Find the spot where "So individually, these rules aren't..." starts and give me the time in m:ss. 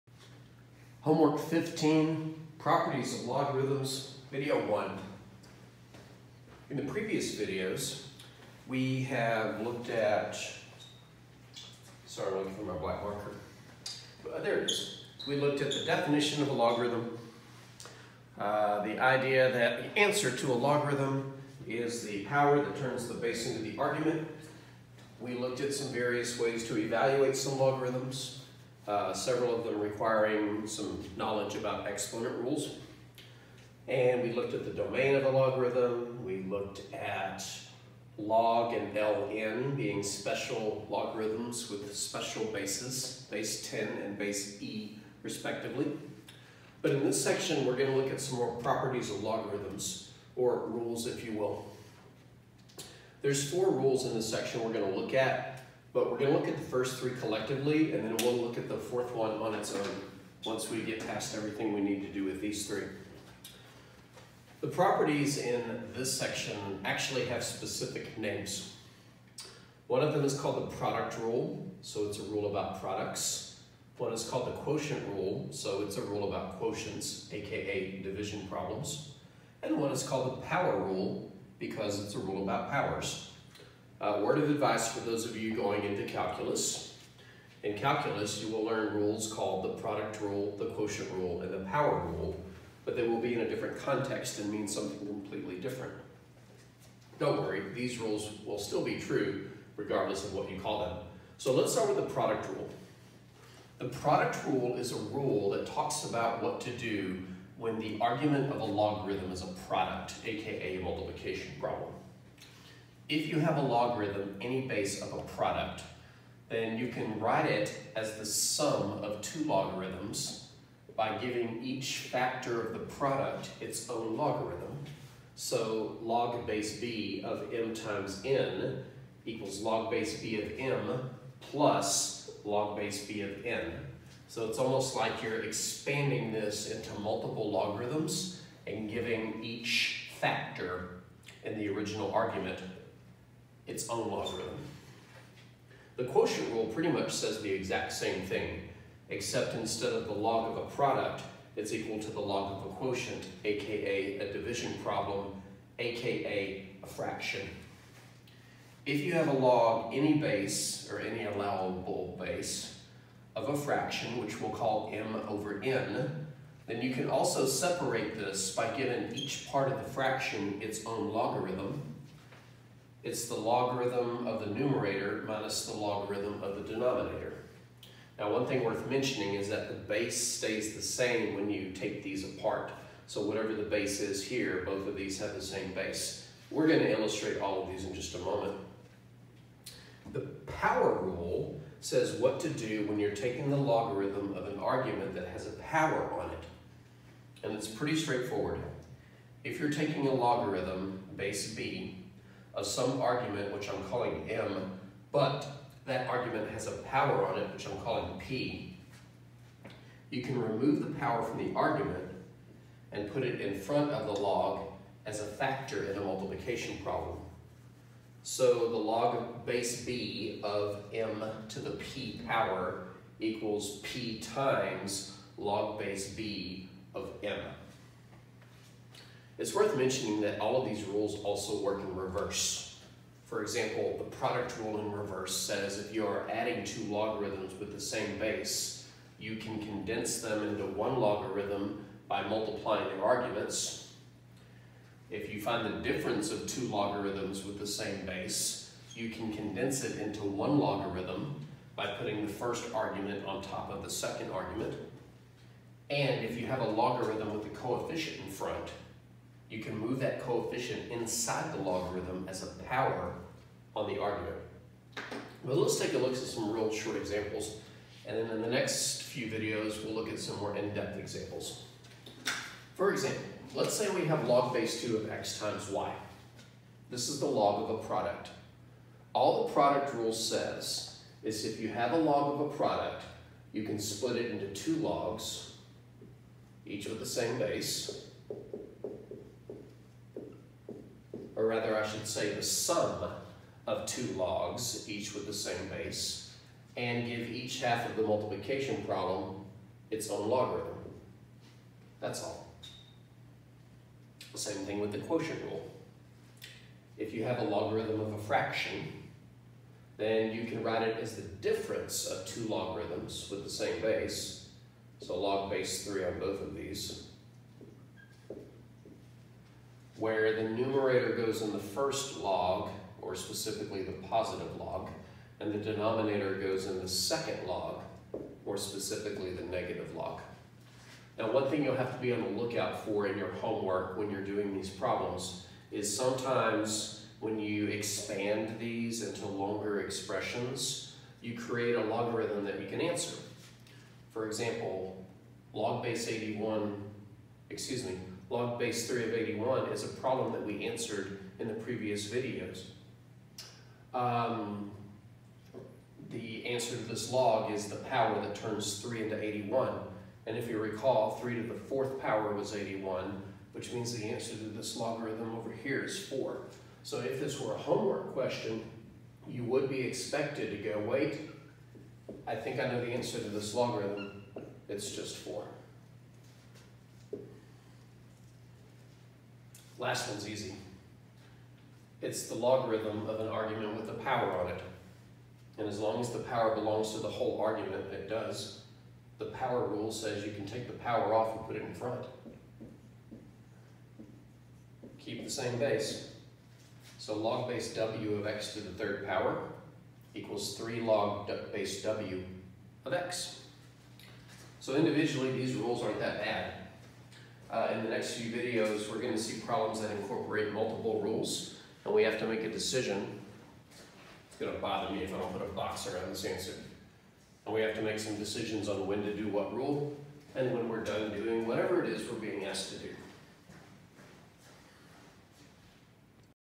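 6:44.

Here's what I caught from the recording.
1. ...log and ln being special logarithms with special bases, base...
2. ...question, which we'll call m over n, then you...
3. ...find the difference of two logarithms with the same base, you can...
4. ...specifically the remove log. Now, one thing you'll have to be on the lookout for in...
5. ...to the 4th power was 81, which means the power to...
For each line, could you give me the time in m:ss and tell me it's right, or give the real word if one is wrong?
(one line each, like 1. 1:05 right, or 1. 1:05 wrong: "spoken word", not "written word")
1. 0:38 right
2. 2:43 wrong: "fraction", not "question"
3. 4:05 right
4. 5:28 wrong: "negative", not "remove"
5. 6:01 wrong: "answer", not "power".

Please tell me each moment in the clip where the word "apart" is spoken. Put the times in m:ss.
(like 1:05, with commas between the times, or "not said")
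3:02.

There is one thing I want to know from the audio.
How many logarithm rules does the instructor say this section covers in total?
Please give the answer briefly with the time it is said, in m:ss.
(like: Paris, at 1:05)
4, at 0:53.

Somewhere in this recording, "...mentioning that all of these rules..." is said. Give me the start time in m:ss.
3:49.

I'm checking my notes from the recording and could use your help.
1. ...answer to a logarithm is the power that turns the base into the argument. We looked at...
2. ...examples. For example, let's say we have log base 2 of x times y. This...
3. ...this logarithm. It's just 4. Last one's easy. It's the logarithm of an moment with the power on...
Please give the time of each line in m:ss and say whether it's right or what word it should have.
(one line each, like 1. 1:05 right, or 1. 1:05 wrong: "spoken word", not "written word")
1. 0:19 right
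2. 4:30 right
3. 6:13 wrong: "argument", not "moment".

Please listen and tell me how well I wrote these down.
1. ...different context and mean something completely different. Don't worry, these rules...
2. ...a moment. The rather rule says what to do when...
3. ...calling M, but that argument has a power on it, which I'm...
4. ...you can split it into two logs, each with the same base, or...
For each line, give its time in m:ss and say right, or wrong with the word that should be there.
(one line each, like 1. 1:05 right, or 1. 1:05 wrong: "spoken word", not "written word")
1. 1:33 right
2. 3:08 wrong: "power", not "rather"
3. 3:23 right
4. 4:43 right.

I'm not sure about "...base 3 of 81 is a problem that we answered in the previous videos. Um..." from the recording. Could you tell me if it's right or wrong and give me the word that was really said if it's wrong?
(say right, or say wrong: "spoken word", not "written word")
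right.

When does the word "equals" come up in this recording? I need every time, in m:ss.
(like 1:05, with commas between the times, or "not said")
2:09, 2:31, 3:43, 6:40.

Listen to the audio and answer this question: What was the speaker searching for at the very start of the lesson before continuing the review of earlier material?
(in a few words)
black marker.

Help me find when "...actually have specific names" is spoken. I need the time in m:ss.
1:06.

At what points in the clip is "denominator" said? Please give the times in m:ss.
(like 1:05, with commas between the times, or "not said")
2:56, 5:25.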